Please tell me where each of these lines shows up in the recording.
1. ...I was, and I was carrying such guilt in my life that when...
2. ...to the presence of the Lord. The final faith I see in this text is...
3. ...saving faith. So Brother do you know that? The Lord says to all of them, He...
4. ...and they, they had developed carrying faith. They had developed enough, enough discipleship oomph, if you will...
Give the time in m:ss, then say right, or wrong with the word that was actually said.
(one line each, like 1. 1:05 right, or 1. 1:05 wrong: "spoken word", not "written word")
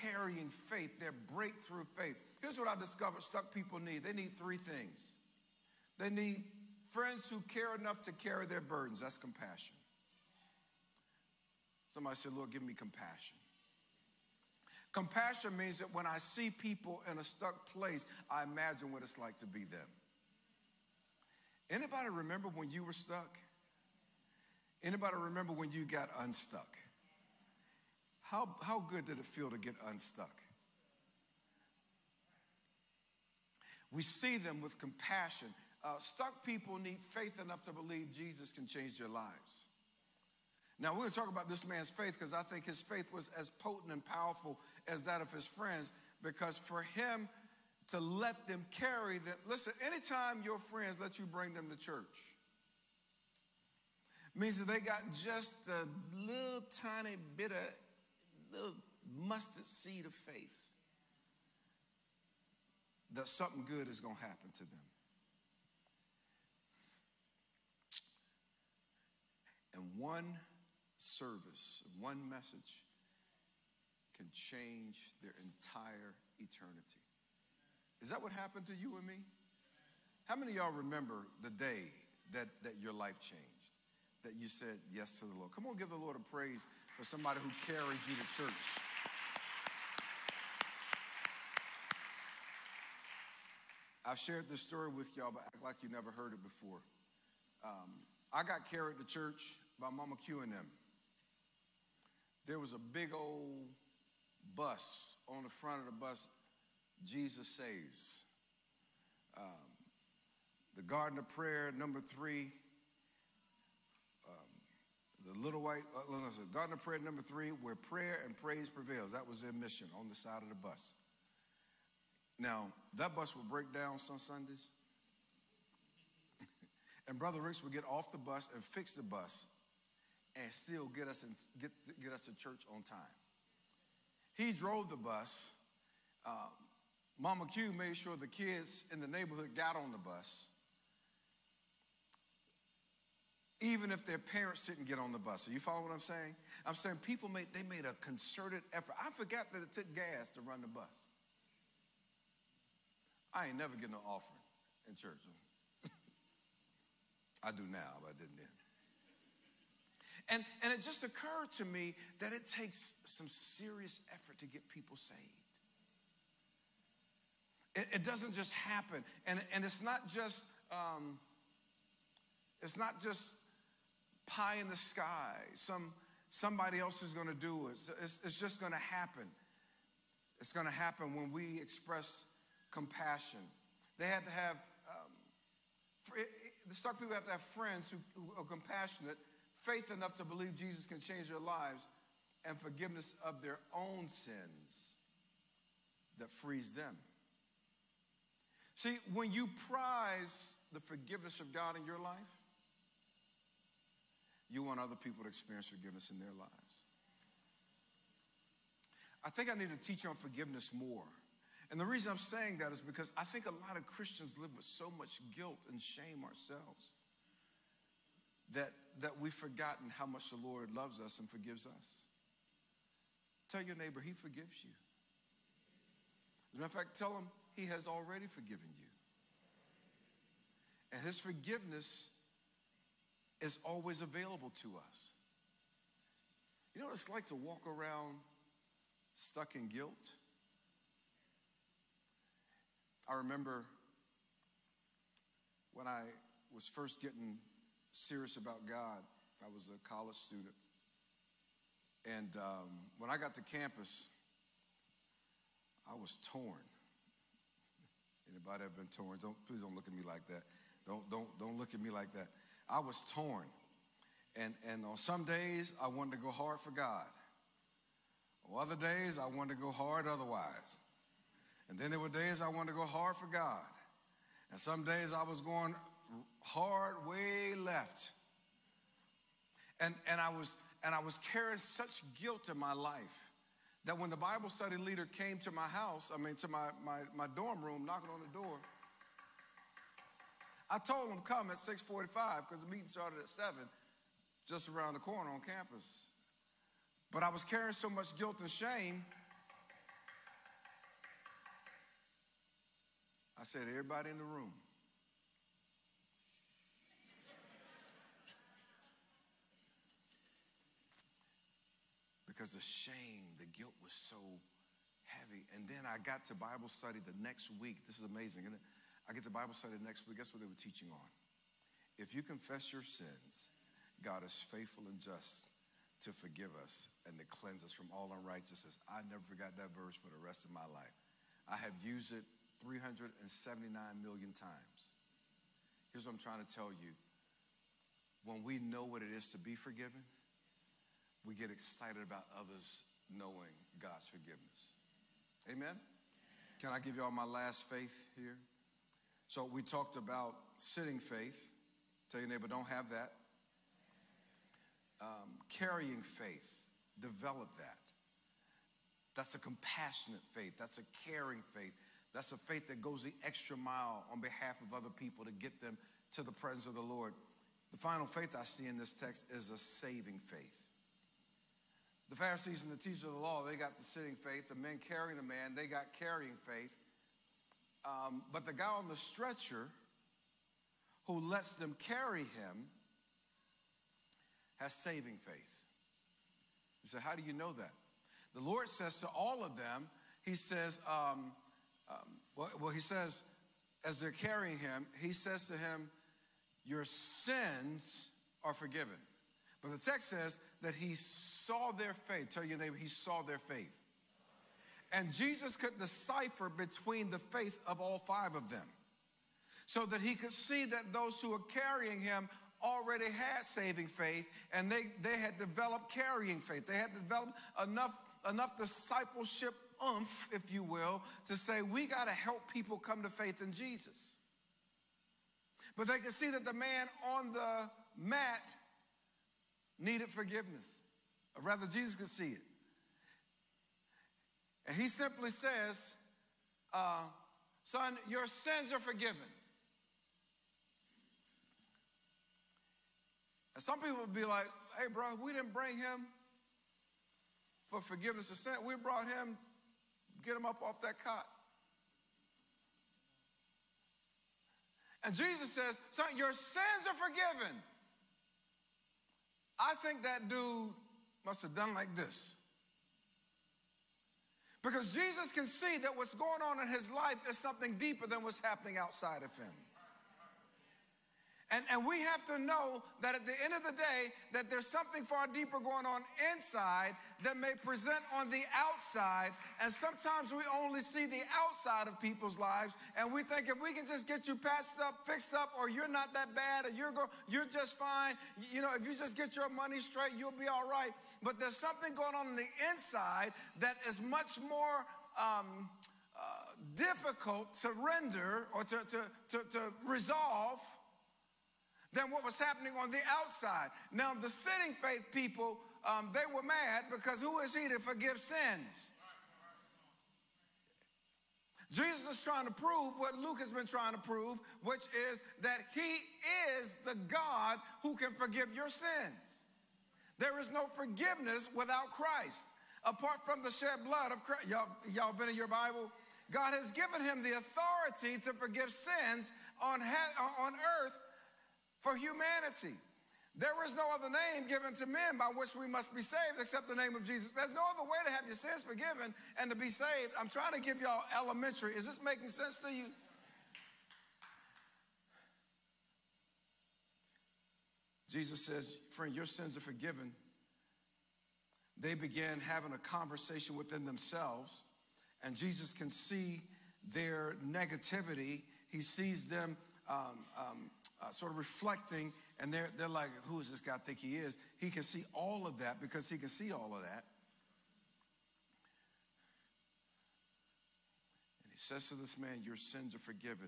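1. 4:40 right
2. 6:06 right
3. 6:24 wrong: "How", not "Brother"
4. 6:54 right.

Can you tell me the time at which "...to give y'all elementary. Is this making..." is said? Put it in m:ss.
9:00.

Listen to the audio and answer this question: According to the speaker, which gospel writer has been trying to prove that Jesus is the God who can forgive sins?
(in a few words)
Luke.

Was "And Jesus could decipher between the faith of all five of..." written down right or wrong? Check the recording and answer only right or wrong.
right.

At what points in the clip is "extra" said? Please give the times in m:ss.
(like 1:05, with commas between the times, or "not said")
6:03.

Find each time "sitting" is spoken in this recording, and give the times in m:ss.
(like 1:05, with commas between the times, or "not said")
5:50, 6:13, 8:24.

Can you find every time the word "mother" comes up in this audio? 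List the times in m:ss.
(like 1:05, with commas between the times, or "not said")
not said.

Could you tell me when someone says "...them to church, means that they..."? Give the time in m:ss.
0:51.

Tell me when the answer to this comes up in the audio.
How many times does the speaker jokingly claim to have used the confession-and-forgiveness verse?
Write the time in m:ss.
5:32.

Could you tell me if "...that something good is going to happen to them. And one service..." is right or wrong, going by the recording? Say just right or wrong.
right.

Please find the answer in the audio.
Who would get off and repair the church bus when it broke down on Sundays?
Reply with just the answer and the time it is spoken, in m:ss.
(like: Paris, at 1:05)
Brother Ricks, at 2:07.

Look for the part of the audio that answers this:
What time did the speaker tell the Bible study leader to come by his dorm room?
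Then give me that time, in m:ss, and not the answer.
4:51.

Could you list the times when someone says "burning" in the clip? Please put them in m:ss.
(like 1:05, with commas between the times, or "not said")
not said.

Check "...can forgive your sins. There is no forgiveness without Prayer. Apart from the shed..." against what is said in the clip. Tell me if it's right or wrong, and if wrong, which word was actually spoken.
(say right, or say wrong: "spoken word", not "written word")
wrong: "Christ", not "Prayer".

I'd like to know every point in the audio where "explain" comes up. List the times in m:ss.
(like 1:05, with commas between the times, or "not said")
not said.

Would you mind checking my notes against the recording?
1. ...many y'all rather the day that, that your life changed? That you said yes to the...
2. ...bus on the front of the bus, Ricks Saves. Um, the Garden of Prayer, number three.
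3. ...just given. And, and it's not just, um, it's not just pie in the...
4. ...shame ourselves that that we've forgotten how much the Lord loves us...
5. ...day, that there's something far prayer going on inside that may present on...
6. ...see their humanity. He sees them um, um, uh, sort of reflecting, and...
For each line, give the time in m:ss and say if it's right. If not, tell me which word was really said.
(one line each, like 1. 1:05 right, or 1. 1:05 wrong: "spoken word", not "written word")
1. 1:20 wrong: "remember", not "rather"
2. 1:44 wrong: "Jesus", not "Ricks"
3. 2:48 wrong: "happen", not "given"
4. 3:35 right
5. 7:53 wrong: "deeper", not "prayer"
6. 9:15 wrong: "negativity", not "humanity".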